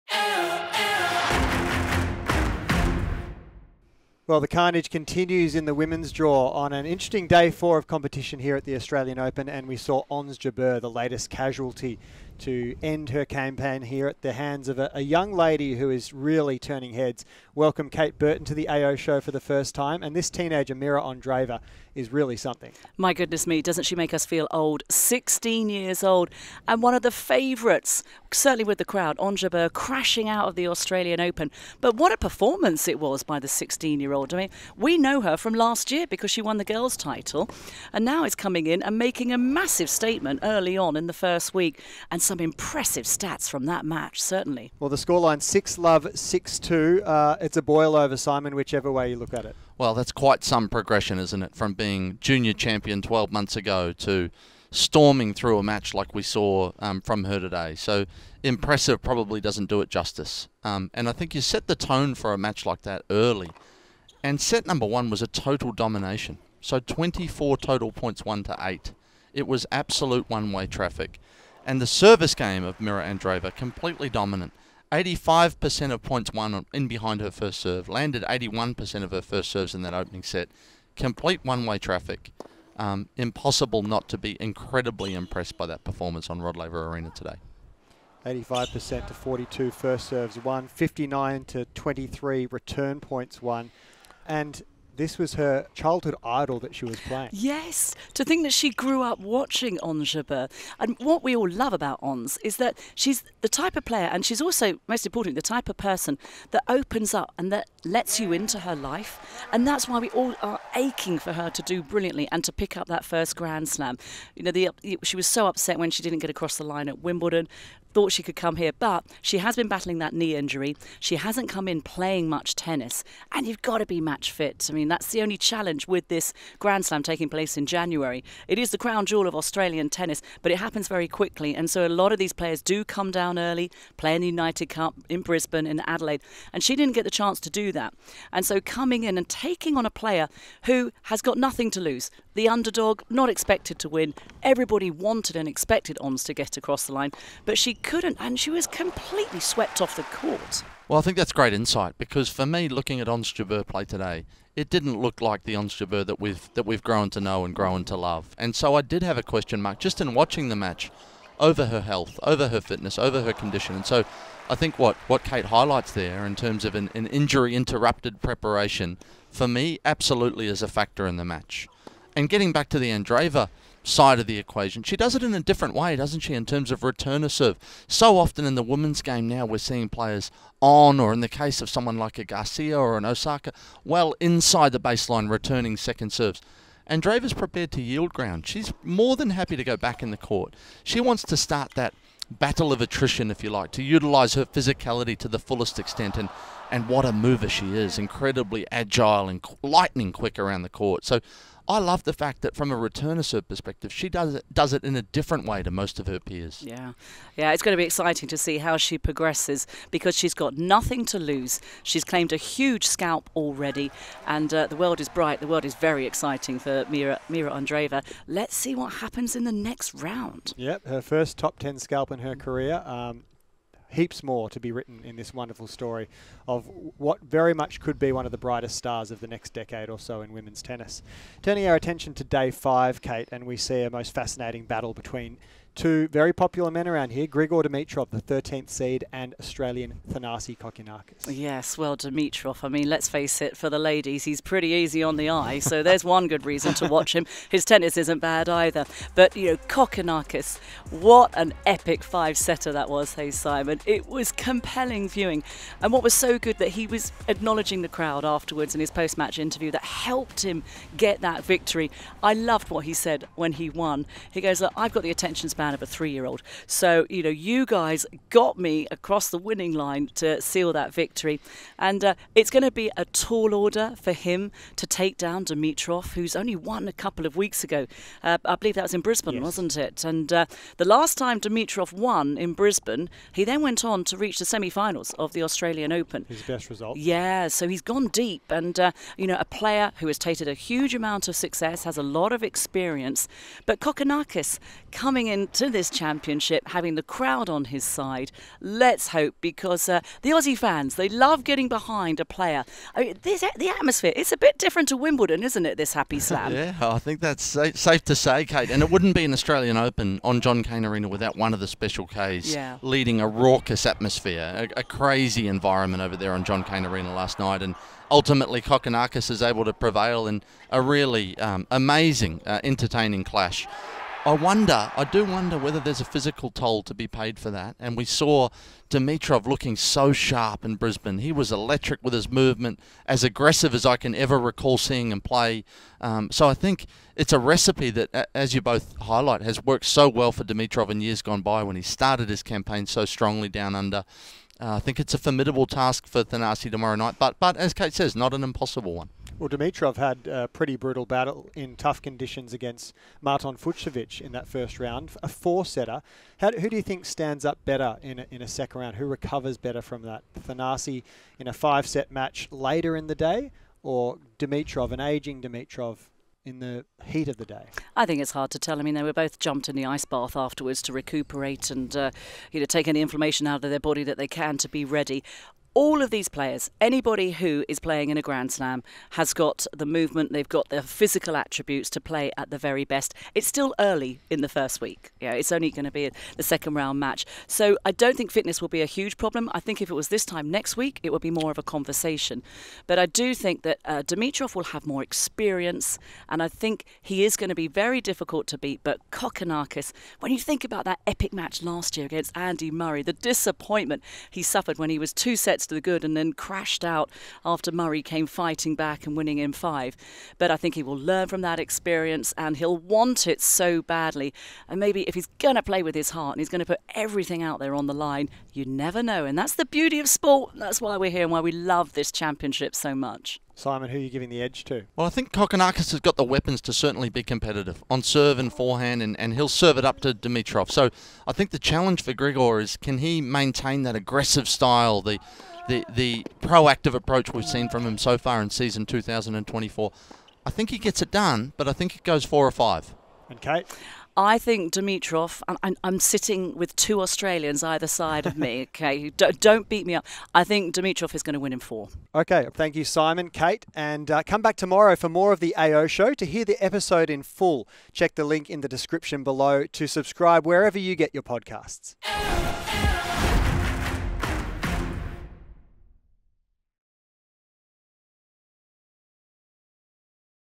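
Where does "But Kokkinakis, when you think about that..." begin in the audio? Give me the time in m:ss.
6:38.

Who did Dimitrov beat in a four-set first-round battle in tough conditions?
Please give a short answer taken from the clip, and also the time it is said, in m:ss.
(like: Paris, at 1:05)
Martin Fucsovics, at 5:53.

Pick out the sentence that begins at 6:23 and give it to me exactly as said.
It's still early in the first week.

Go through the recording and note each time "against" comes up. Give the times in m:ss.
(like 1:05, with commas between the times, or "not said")
5:52, 6:42.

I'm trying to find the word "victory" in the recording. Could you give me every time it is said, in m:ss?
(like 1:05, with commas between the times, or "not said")
4:21, 4:30.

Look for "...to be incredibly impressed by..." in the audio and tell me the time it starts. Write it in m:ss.
1:24.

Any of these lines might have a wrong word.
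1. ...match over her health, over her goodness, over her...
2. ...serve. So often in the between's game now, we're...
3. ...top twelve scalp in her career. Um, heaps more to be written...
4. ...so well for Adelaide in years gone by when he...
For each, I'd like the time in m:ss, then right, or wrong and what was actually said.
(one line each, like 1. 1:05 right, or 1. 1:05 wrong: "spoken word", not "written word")
1. 2:40 wrong: "fitness", not "goodness"
2. 2:57 wrong: "women", not "between"
3. 3:41 wrong: "ten", not "twelve"
4. 5:39 wrong: "Dimitrov", not "Adelaide".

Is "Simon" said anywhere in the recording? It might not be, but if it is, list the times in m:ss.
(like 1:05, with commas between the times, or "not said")
0:48, 4:13, 7:03, 7:32.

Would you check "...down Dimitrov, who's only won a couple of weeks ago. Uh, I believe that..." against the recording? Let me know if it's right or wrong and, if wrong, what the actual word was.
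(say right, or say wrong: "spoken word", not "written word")
right.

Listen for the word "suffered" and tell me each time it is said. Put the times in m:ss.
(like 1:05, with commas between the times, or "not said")
6:44.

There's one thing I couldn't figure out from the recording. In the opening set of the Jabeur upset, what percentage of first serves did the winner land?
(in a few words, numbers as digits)
81%.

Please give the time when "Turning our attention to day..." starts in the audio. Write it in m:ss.
3:51.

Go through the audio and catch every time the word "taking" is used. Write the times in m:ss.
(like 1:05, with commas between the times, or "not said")
2:07, 2:19.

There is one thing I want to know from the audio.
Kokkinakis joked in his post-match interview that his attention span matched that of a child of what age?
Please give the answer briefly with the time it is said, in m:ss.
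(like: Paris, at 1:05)
3, at 4:25.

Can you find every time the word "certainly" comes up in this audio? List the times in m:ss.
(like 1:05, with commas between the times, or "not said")
0:28, 0:44, 7:06.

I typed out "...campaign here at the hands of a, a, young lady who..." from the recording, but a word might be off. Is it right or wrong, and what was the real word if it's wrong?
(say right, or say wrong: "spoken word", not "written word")
right.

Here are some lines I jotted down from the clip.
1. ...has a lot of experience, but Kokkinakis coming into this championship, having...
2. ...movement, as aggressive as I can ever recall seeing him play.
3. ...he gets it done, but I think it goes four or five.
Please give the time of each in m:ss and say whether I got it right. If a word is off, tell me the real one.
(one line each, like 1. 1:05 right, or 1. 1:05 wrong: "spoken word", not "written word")
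1. 4:51 right
2. 5:32 right
3. 7:20 right.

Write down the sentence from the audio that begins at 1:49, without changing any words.
And that's why we all are aching for her to do brilliantly and to pick up that first Grand Slam.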